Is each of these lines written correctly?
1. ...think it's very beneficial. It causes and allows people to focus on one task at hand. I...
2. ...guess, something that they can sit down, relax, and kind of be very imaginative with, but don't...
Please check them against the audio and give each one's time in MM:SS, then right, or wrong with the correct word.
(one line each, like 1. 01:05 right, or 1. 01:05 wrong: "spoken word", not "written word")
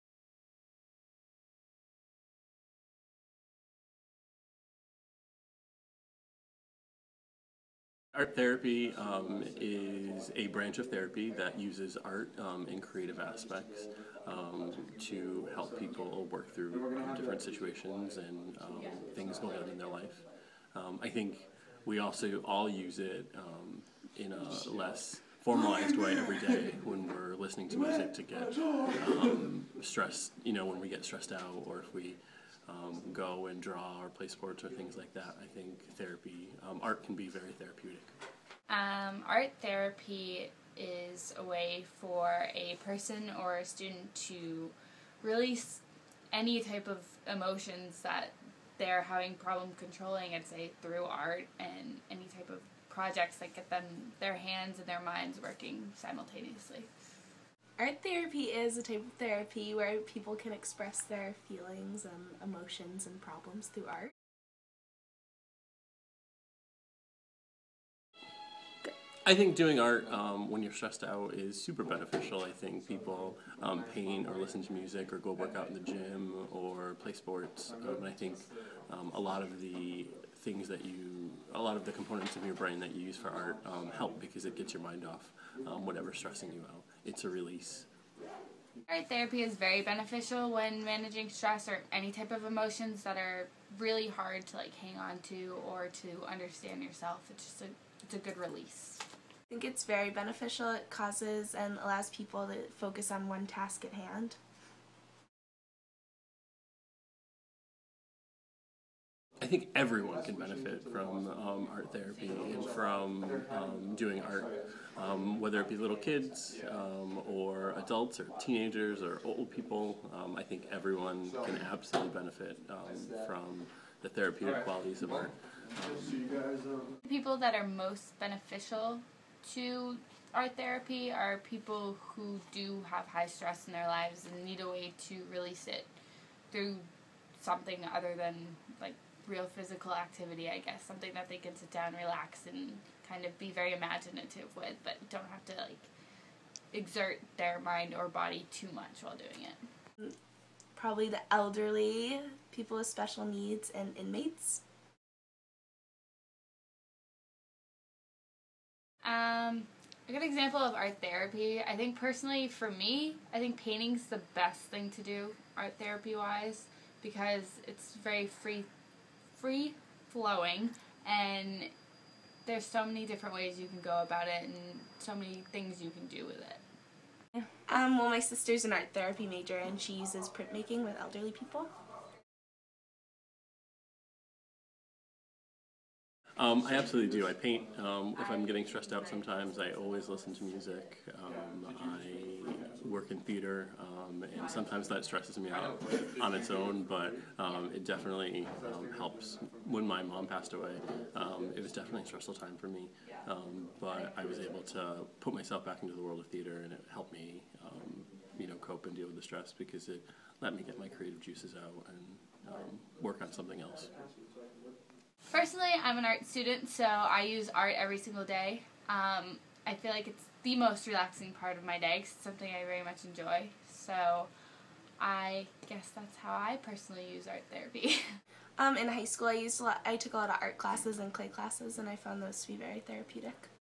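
1. 01:39 right
2. 02:20 right.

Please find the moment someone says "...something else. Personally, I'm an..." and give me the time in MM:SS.
03:33.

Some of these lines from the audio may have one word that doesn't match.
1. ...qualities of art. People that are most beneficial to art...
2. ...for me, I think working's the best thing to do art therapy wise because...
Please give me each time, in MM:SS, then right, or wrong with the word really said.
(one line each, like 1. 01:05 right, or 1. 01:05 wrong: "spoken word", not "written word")
1. 02:04 right
2. 02:42 wrong: "painting", not "working".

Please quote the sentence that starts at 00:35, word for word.
I think therapy, um, art can be very therapeutic.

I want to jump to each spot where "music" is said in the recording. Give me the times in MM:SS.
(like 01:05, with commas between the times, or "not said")
00:27, 01:14, 03:10.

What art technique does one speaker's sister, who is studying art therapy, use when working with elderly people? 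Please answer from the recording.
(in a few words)
printmaking.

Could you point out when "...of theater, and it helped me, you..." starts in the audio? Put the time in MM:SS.
03:26.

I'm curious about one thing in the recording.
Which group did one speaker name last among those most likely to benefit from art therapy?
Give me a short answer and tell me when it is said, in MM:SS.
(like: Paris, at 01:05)
inmates, at 02:33.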